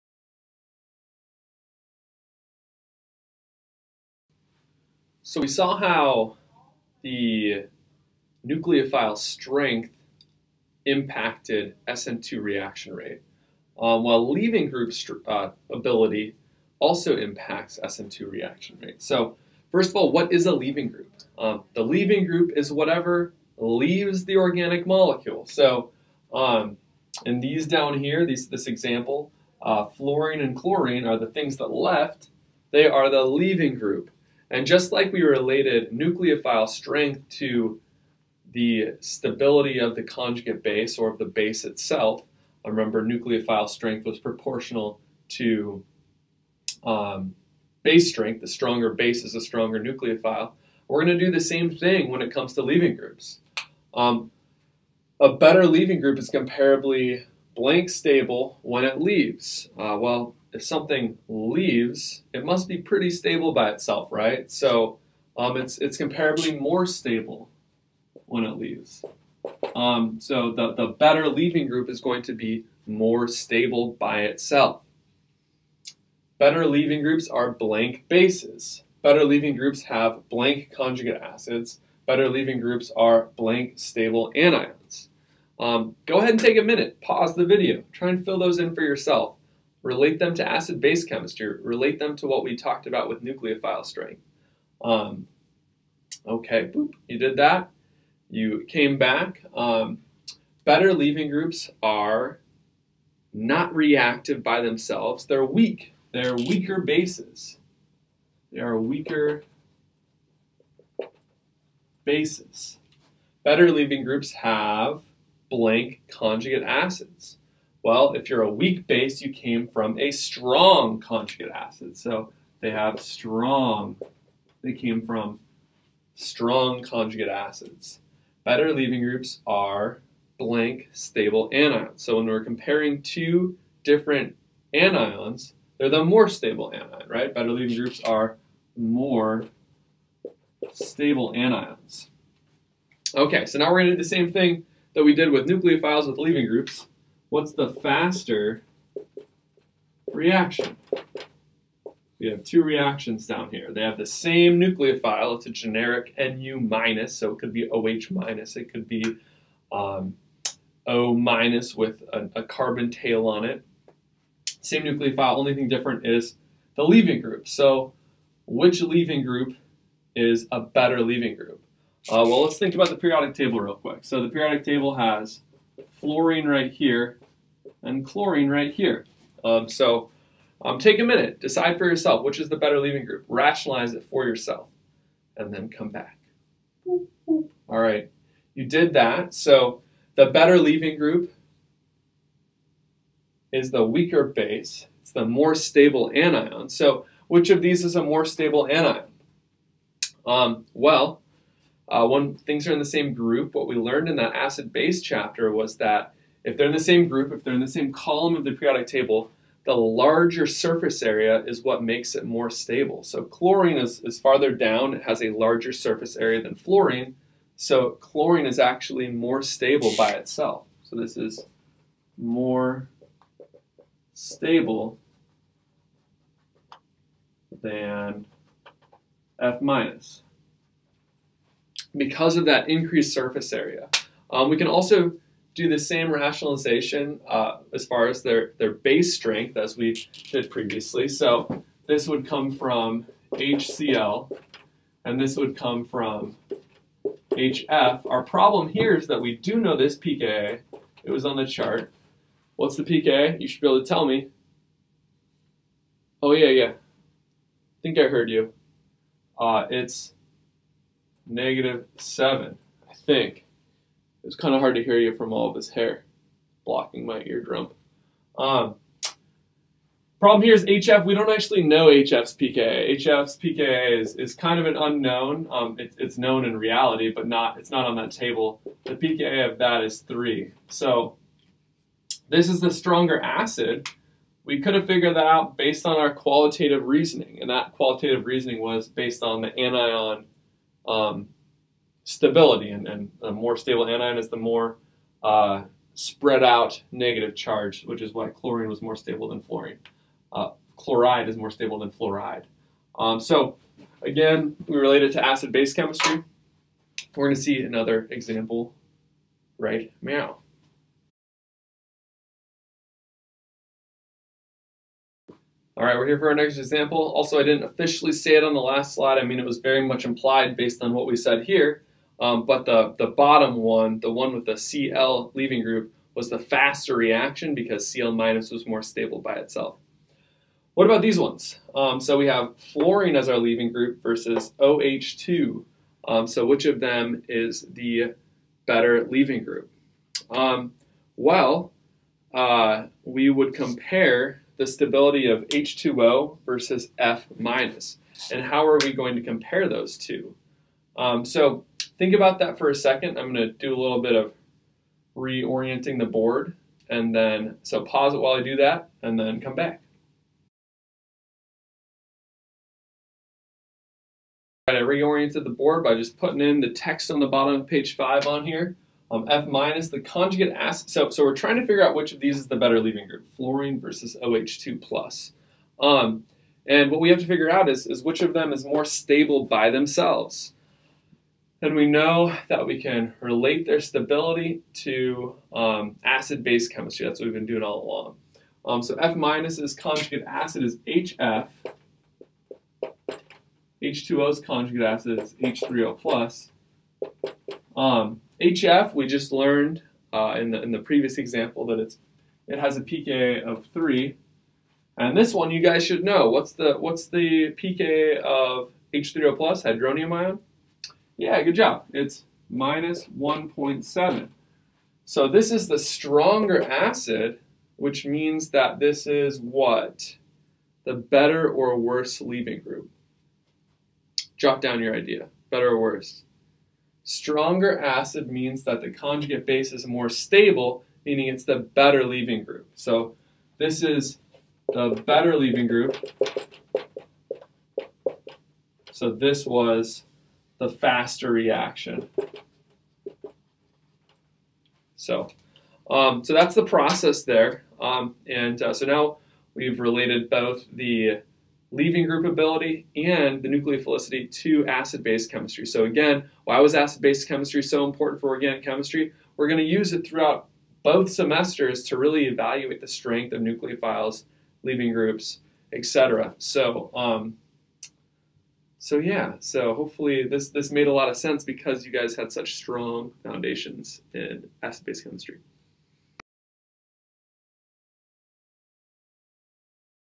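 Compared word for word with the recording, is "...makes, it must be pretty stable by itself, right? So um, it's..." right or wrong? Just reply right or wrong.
wrong.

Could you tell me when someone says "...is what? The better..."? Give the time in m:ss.
6:59.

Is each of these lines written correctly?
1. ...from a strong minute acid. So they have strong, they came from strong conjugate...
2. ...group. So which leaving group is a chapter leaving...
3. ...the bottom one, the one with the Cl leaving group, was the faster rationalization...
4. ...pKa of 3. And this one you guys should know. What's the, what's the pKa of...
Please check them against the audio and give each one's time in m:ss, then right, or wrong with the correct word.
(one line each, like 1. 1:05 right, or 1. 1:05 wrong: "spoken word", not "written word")
1. 1:59 wrong: "conjugate", not "minute"
2. 2:47 wrong: "better", not "chapter"
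3. 5:22 wrong: "reaction", not "rationalization"
4. 6:42 right.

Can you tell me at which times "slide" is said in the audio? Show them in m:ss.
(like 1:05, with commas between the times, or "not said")
5:18.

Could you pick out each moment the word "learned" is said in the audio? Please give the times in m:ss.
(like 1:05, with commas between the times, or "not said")
3:23, 6:39.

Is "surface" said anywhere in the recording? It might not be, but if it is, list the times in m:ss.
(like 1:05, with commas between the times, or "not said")
3:30, 3:35, 3:53.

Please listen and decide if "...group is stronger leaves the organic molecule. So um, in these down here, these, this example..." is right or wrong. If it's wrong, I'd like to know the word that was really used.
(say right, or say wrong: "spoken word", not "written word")
wrong: "whatever", not "stronger".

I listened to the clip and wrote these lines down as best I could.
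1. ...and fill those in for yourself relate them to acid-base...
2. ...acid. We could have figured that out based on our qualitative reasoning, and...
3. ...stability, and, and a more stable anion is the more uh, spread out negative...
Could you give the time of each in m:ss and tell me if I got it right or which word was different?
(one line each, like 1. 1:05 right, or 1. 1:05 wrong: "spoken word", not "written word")
1. 1:28 right
2. 4:43 right
3. 4:52 right.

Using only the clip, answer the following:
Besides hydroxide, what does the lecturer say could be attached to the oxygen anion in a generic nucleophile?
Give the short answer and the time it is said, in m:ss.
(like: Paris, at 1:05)
a carbon tail, at 2:42.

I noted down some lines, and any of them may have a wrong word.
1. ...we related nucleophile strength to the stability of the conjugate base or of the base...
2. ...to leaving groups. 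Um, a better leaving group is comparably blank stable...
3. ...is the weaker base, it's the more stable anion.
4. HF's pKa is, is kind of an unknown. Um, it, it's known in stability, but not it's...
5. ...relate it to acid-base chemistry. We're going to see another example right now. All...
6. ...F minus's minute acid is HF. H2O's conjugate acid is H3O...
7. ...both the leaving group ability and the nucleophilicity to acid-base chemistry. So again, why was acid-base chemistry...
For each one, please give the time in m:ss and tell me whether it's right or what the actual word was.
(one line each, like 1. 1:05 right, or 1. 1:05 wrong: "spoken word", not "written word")
1. 0:35 right
2. 0:52 right
3. 3:13 right
4. 4:32 wrong: "reality", not "stability"
5. 5:04 right
6. 6:28 wrong: "conjugate", not "minute"
7. 7:30 right.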